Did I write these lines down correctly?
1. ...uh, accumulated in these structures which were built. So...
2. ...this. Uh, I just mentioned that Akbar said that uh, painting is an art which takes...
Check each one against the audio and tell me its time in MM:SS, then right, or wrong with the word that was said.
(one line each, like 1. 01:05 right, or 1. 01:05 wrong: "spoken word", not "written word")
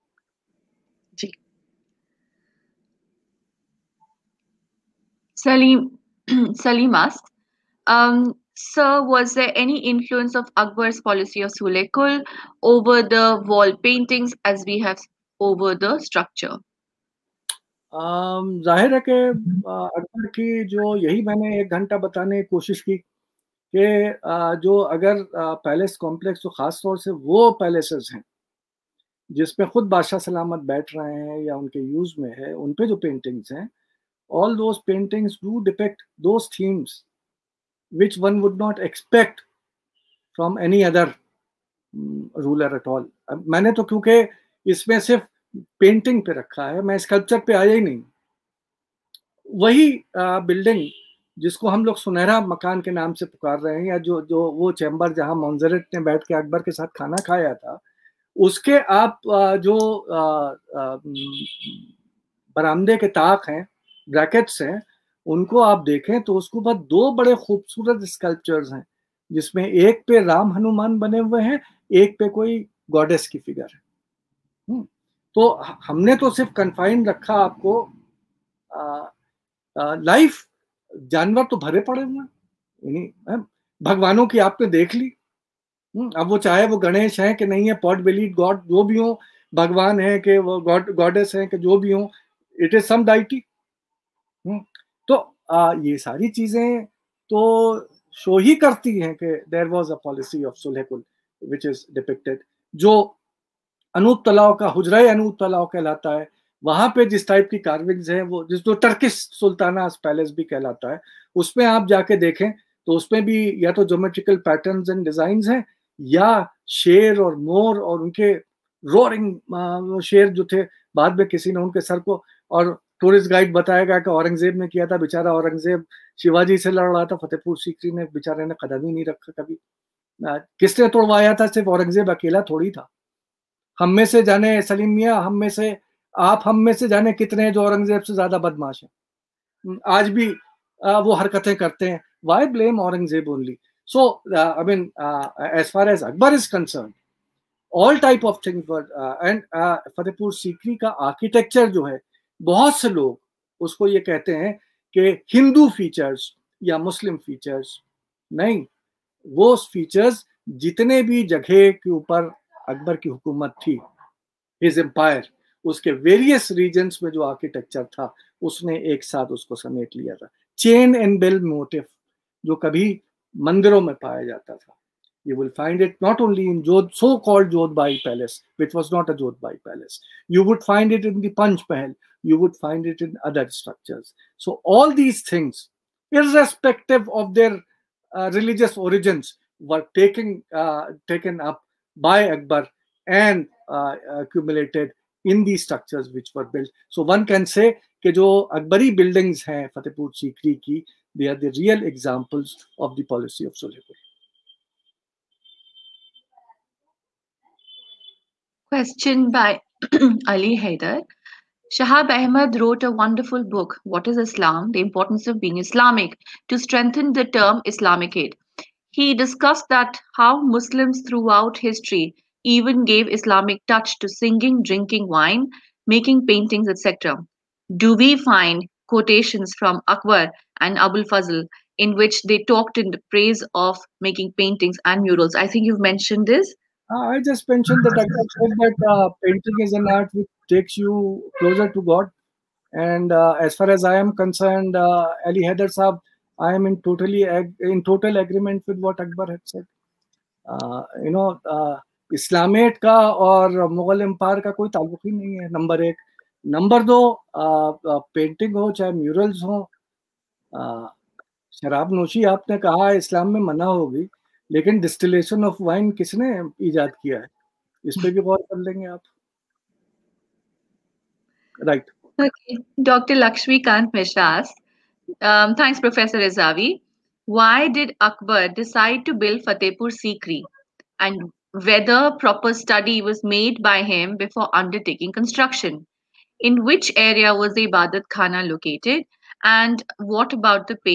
1. 03:13 right
2. 03:56 right.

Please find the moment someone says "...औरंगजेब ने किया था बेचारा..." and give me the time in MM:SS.
02:04.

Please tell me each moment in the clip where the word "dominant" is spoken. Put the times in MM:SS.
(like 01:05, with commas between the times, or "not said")
not said.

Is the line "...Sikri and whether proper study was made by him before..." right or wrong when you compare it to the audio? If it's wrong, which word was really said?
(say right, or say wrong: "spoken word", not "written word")
right.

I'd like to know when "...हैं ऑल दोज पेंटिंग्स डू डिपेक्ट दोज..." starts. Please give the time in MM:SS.
00:33.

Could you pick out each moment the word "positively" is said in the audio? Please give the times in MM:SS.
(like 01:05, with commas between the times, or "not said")
not said.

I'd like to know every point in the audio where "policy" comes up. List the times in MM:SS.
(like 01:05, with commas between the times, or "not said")
00:11, 03:23.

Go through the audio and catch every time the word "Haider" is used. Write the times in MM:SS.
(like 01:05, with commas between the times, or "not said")
03:30, 04:05.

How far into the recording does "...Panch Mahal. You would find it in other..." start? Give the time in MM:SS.
03:01.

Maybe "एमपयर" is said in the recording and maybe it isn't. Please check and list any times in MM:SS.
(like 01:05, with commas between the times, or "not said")
02:44, 04:14.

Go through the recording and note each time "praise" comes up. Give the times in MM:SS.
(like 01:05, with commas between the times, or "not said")
03:53.